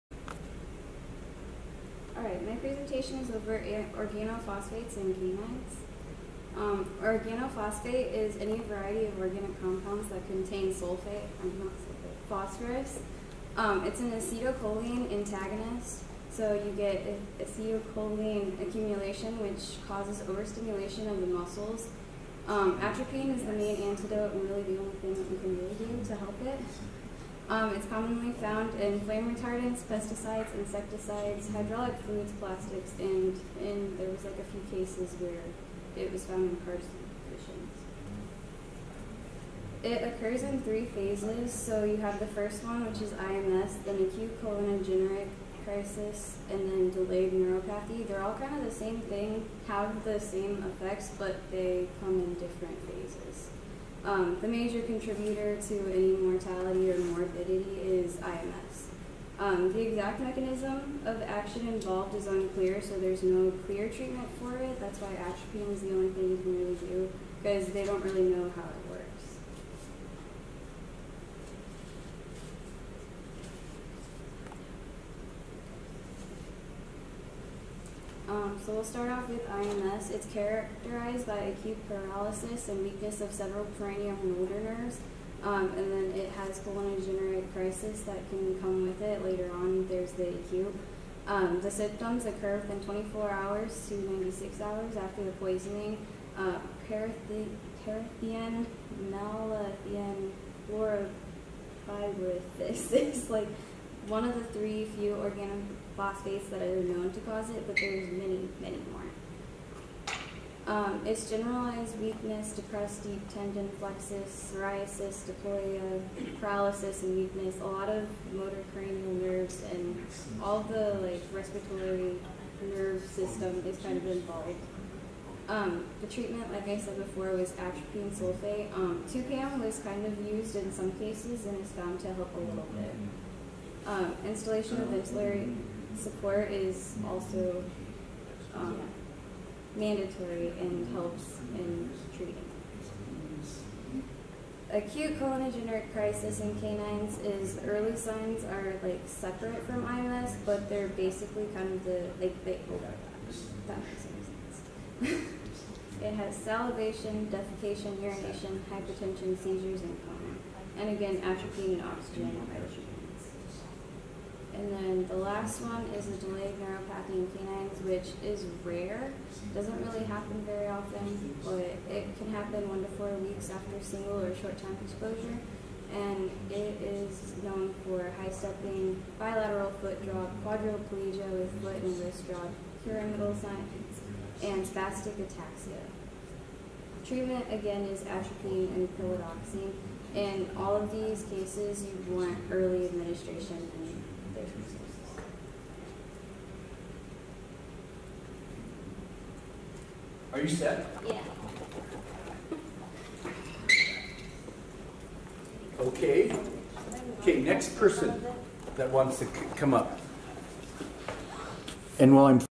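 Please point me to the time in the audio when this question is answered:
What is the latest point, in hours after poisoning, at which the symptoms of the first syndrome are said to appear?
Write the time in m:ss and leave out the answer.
1:33.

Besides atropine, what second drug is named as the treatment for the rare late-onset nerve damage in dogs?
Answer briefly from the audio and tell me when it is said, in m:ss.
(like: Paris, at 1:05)
Pilodoxine, at 3:08.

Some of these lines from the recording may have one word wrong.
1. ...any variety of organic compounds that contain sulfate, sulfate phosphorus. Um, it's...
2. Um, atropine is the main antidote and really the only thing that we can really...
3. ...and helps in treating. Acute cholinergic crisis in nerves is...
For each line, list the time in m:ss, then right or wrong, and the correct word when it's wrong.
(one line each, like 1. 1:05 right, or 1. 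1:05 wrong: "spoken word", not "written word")
1. 0:08 right
2. 0:22 right
3. 2:20 wrong: "canines", not "nerves".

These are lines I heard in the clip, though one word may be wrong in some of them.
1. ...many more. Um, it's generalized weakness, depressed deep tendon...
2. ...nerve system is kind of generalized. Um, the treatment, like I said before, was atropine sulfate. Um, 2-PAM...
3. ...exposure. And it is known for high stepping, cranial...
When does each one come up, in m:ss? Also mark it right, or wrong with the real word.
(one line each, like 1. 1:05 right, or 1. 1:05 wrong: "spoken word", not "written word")
1. 1:48 right
2. 2:02 wrong: "involved", not "generalized"
3. 2:54 wrong: "bilateral", not "cranial".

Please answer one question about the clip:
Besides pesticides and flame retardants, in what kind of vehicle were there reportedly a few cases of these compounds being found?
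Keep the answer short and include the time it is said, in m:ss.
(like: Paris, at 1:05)
Cars, at 0:36.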